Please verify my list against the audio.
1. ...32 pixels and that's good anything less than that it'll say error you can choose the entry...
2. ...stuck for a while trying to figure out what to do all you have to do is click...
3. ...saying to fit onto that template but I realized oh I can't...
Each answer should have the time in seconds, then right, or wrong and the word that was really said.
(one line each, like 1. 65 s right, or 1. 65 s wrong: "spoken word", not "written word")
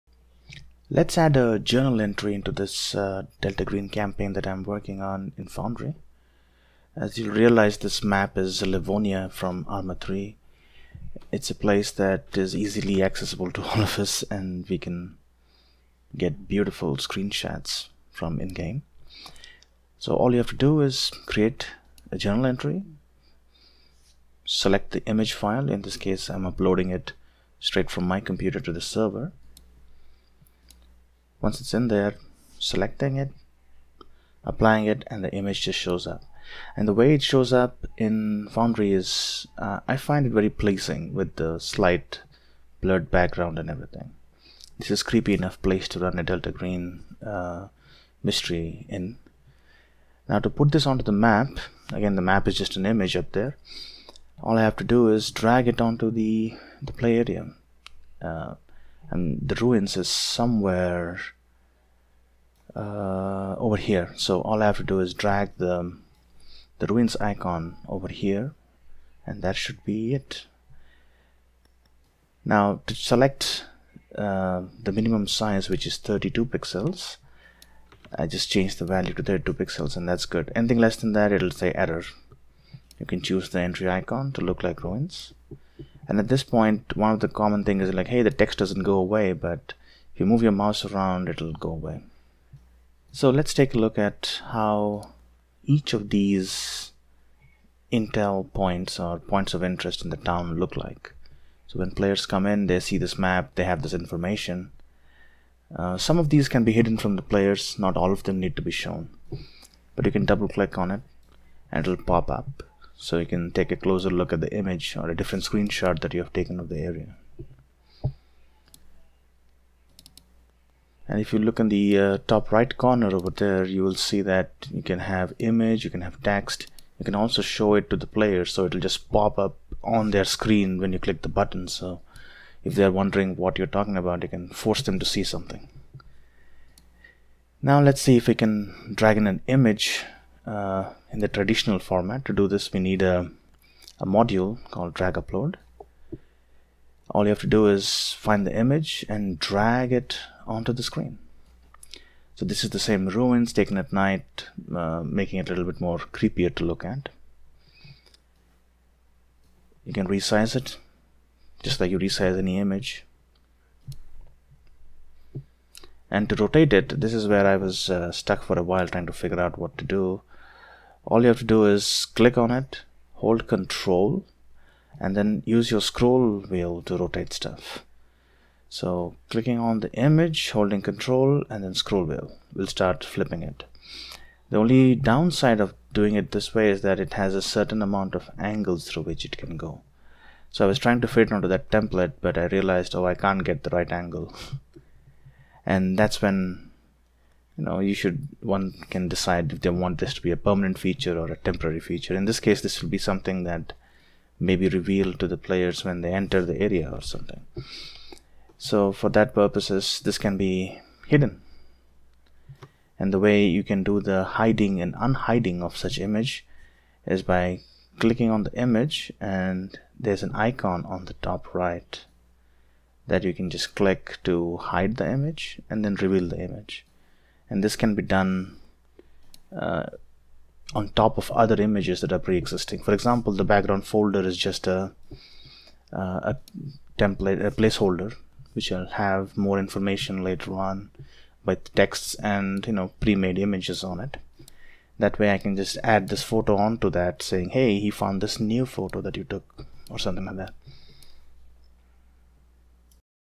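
1. 79 s right
2. 168 s right
3. 190 s wrong: "trying", not "saying".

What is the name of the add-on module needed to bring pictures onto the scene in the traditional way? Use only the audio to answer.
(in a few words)
Drag Upload.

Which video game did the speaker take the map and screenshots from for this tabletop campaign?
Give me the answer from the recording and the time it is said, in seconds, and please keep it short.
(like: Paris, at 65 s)
Arma 3, at 9 s.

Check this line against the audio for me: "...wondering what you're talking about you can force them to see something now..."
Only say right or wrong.
right.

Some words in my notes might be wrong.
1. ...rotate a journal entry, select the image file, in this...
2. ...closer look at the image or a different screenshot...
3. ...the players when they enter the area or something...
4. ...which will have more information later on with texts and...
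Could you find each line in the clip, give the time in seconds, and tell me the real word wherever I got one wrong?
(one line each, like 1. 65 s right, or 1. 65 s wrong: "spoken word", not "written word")
1. 21 s wrong: "create", not "rotate"
2. 113 s right
3. 205 s right
4. 238 s right.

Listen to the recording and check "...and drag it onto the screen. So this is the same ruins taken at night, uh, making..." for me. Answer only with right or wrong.
right.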